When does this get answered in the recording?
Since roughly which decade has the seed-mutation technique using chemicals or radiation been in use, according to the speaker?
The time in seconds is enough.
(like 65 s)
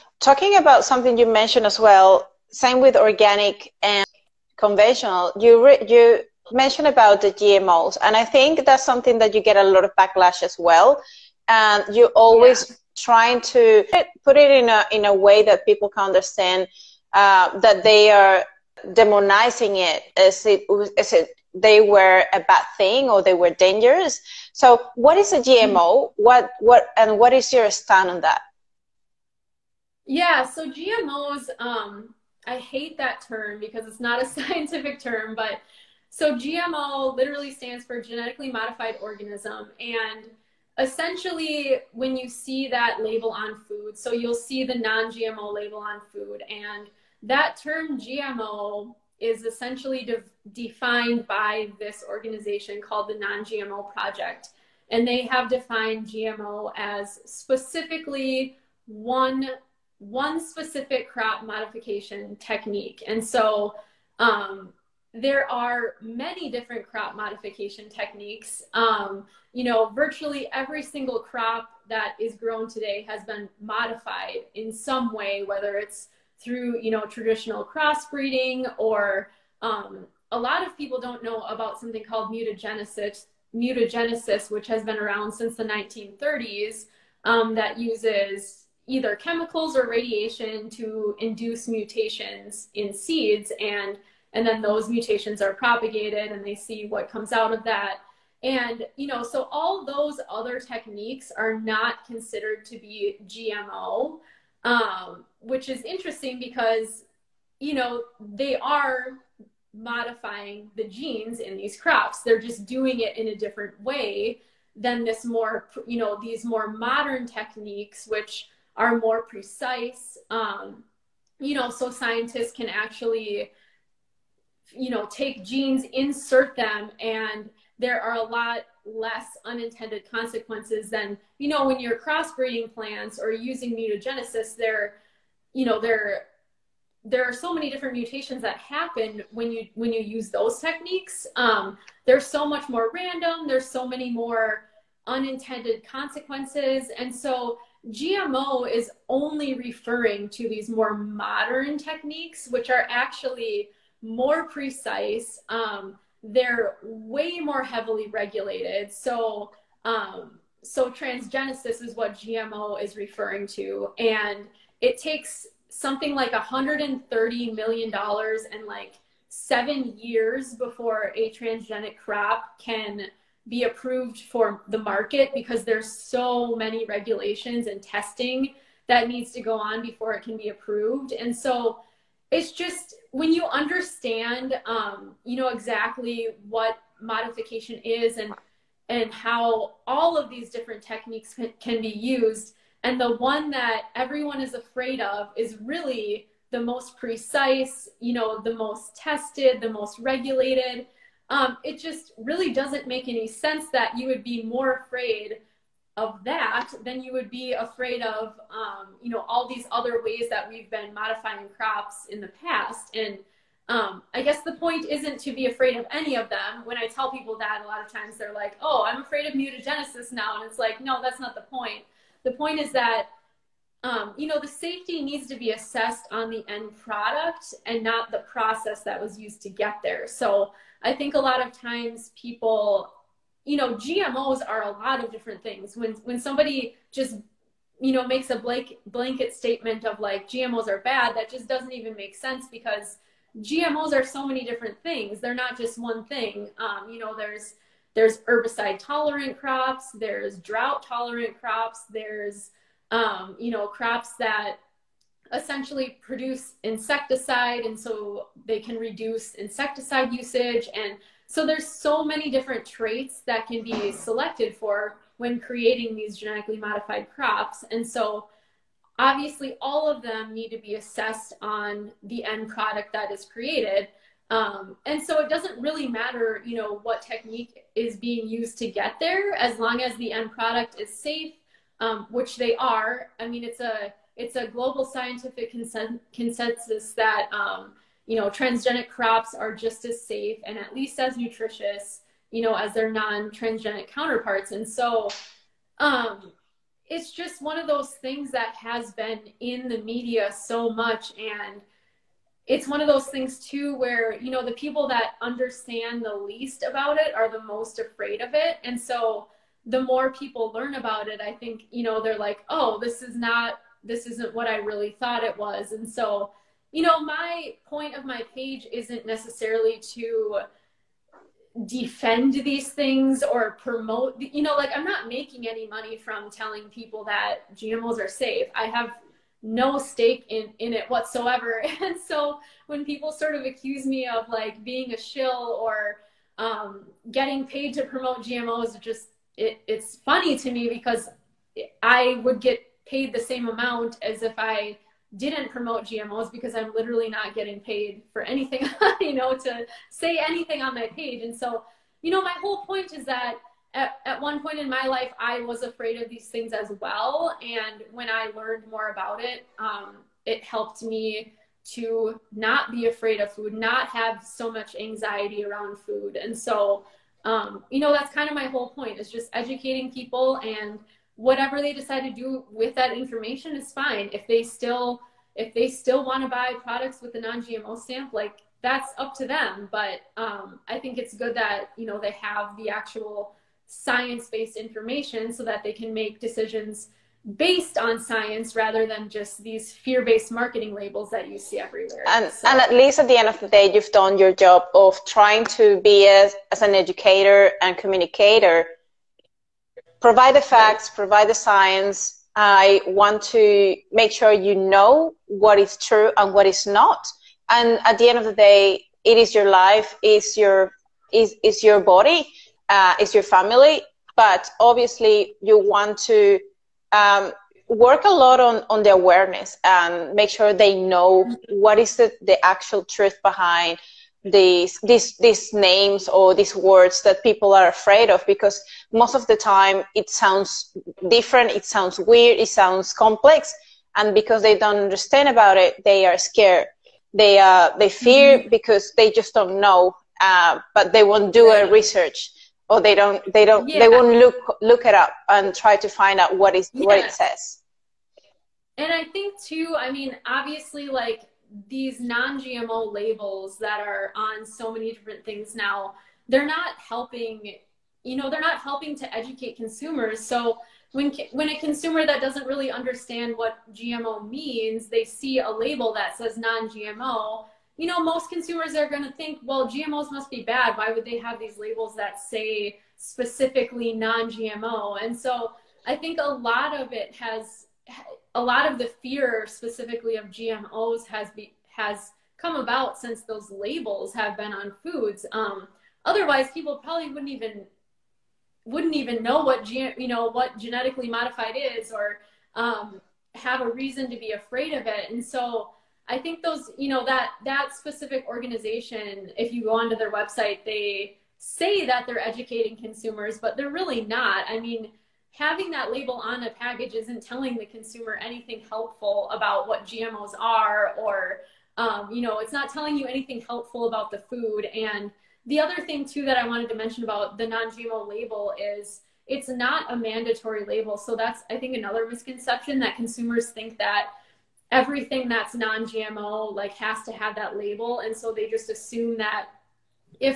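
85 s.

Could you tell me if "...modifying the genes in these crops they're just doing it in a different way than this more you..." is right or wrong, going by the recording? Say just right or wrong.
right.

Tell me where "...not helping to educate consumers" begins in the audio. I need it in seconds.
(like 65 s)
458 s.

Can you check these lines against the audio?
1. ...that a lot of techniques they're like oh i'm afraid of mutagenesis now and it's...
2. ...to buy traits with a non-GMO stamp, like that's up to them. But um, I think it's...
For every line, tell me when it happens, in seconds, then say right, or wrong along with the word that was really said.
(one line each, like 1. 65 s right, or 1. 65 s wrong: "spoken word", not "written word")
1. 217 s wrong: "times", not "techniques"
2. 376 s wrong: "products", not "traits".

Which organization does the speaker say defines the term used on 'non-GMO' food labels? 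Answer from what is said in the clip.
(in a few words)
Non-GMO Project.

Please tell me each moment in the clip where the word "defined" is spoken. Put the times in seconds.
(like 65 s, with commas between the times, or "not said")
50 s, 55 s.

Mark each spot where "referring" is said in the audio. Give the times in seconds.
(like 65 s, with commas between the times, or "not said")
149 s, 162 s.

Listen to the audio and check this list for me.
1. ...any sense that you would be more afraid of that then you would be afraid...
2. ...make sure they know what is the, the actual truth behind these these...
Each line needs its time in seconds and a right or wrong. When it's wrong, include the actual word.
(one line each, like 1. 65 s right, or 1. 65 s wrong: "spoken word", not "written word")
1. 203 s right
2. 420 s right.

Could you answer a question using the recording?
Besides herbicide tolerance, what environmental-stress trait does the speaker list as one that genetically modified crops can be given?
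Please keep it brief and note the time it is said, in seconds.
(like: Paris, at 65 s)
drought tolerant, at 250 s.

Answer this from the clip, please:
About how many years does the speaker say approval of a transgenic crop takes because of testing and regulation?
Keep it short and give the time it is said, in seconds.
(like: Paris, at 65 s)
7 years, at 169 s.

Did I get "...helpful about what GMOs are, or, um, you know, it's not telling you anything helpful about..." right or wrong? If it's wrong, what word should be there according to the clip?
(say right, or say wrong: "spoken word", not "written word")
right.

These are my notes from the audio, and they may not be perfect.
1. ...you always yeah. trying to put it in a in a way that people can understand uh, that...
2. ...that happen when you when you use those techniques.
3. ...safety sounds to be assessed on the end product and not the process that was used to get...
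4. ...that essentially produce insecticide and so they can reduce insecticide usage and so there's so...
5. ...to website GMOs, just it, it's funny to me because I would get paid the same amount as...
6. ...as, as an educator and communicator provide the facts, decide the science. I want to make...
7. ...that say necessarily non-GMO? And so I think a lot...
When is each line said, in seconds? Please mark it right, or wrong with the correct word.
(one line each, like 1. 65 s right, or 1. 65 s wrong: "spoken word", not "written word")
1. 11 s right
2. 138 s right
3. 224 s wrong: "needs", not "sounds"
4. 254 s right
5. 337 s wrong: "promote", not "website"
6. 396 s wrong: "provide", not "decide"
7. 471 s wrong: "specifically", not "necessarily".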